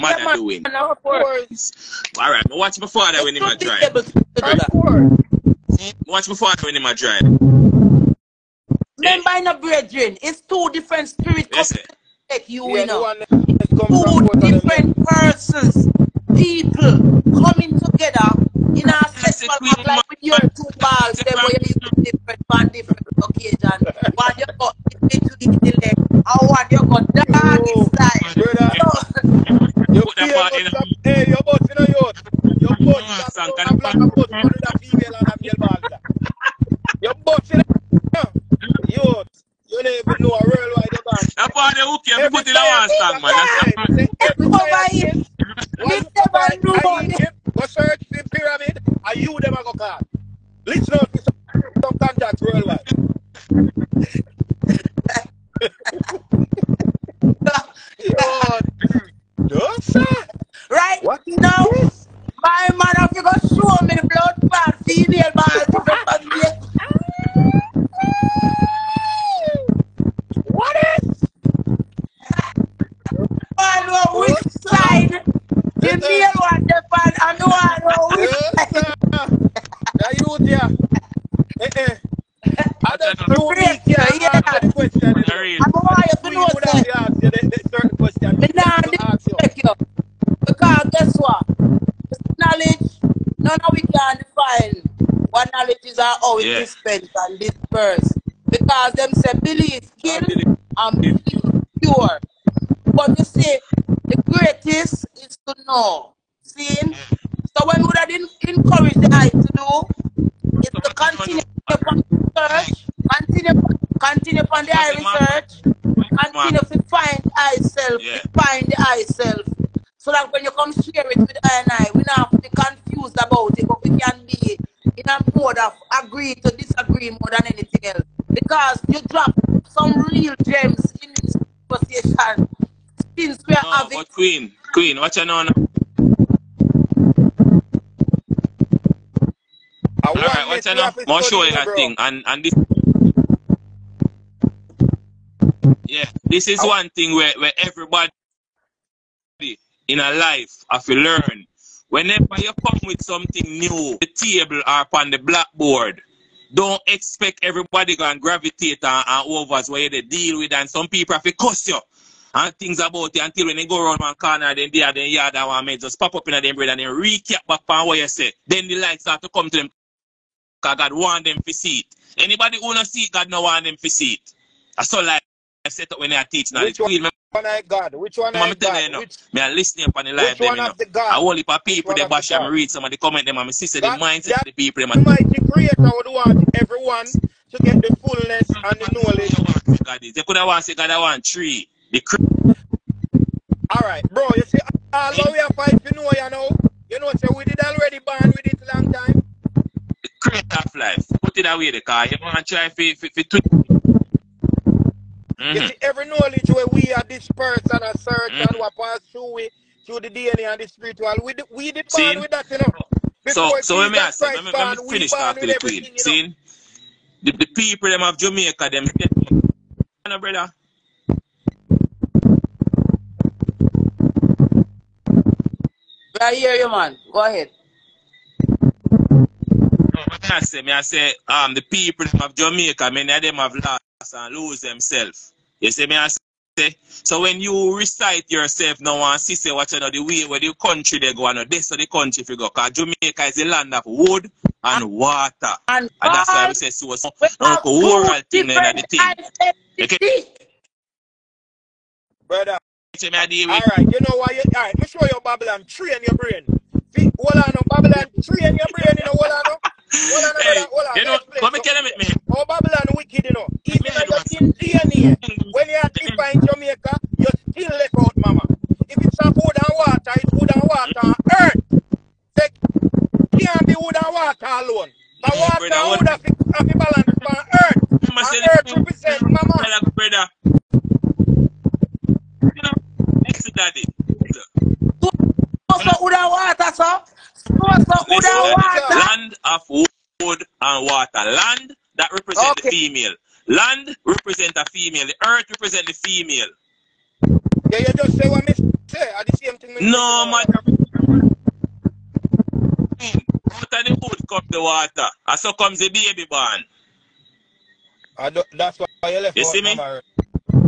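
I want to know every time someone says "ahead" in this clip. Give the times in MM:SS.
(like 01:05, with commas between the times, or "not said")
03:47.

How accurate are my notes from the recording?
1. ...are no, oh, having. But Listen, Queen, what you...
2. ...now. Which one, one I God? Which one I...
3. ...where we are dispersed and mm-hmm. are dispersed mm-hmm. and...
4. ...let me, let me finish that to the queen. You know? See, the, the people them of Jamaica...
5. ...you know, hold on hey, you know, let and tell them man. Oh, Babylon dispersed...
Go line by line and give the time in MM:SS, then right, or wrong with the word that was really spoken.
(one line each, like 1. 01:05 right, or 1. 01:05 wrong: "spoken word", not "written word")
1. 02:13 wrong: "Queen", not "Listen"
2. 02:56 right
3. 03:26 wrong: "searched", not "dispersed"
4. 03:34 right
5. 04:18 wrong: "wicked", not "dispersed".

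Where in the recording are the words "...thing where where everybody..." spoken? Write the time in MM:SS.
02:26.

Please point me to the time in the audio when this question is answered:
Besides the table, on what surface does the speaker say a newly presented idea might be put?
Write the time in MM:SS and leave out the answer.
02:35.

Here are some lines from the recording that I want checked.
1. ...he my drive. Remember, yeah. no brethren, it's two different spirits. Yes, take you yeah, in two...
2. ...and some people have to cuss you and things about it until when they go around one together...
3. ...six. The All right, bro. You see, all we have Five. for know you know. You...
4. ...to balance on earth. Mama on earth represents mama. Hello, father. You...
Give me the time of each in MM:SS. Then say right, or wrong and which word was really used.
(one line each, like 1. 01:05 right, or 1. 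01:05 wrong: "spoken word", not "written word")
1. 00:06 right
2. 02:40 wrong: "corner", not "together"
3. 03:11 wrong: "three", not "six"
4. 04:36 wrong: "brother", not "father".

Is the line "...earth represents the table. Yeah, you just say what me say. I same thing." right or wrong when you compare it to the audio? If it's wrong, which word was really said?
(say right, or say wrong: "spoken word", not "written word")
wrong: "female", not "table".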